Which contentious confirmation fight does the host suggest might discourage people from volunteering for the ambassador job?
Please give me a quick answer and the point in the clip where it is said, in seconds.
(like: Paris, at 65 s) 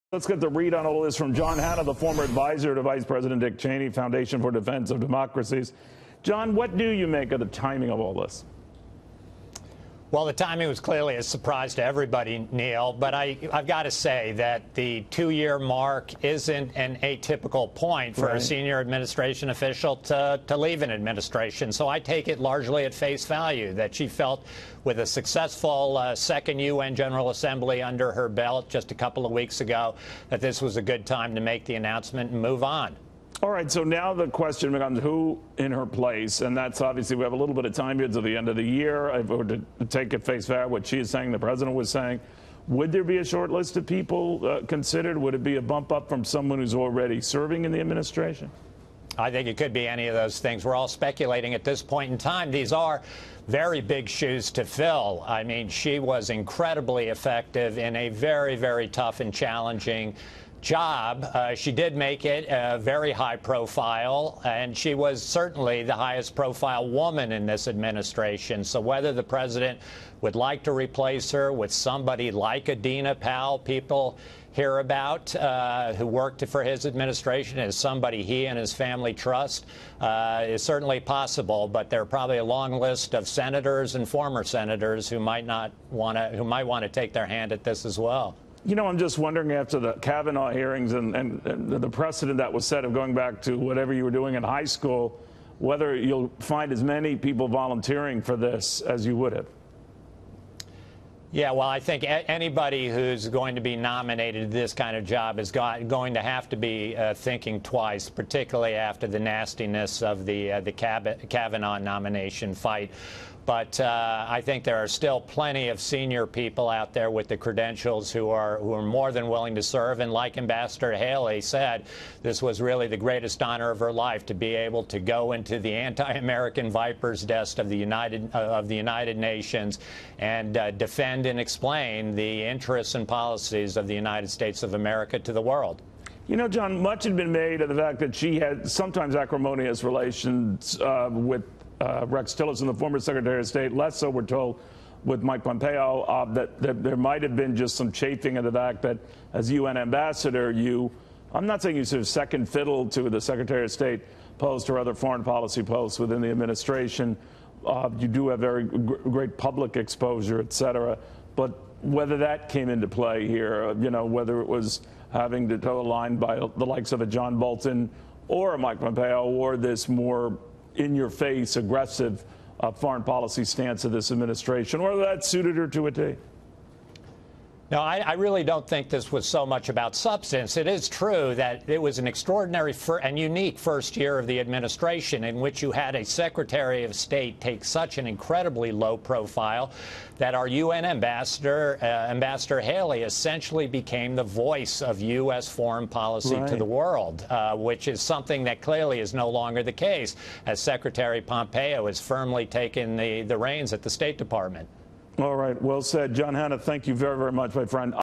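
Kavanaugh hearings, at 89 s.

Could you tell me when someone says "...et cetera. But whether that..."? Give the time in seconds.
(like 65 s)
160 s.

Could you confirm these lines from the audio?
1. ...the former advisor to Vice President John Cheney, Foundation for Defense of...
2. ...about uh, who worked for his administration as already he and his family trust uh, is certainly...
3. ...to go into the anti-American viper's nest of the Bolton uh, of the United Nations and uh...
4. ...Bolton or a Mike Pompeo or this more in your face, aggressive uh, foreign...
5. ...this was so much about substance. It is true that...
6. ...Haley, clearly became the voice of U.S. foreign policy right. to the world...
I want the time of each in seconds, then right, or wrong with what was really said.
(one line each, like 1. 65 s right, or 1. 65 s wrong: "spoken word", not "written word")
1. 1 s wrong: "Dick", not "John"
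2. 74 s wrong: "somebody", not "already"
3. 124 s wrong: "United", not "Bolton"
4. 167 s right
5. 178 s right
6. 192 s wrong: "essentially", not "clearly".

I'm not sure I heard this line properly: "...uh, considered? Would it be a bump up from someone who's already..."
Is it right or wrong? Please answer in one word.
right.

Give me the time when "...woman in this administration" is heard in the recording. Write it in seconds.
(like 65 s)
66 s.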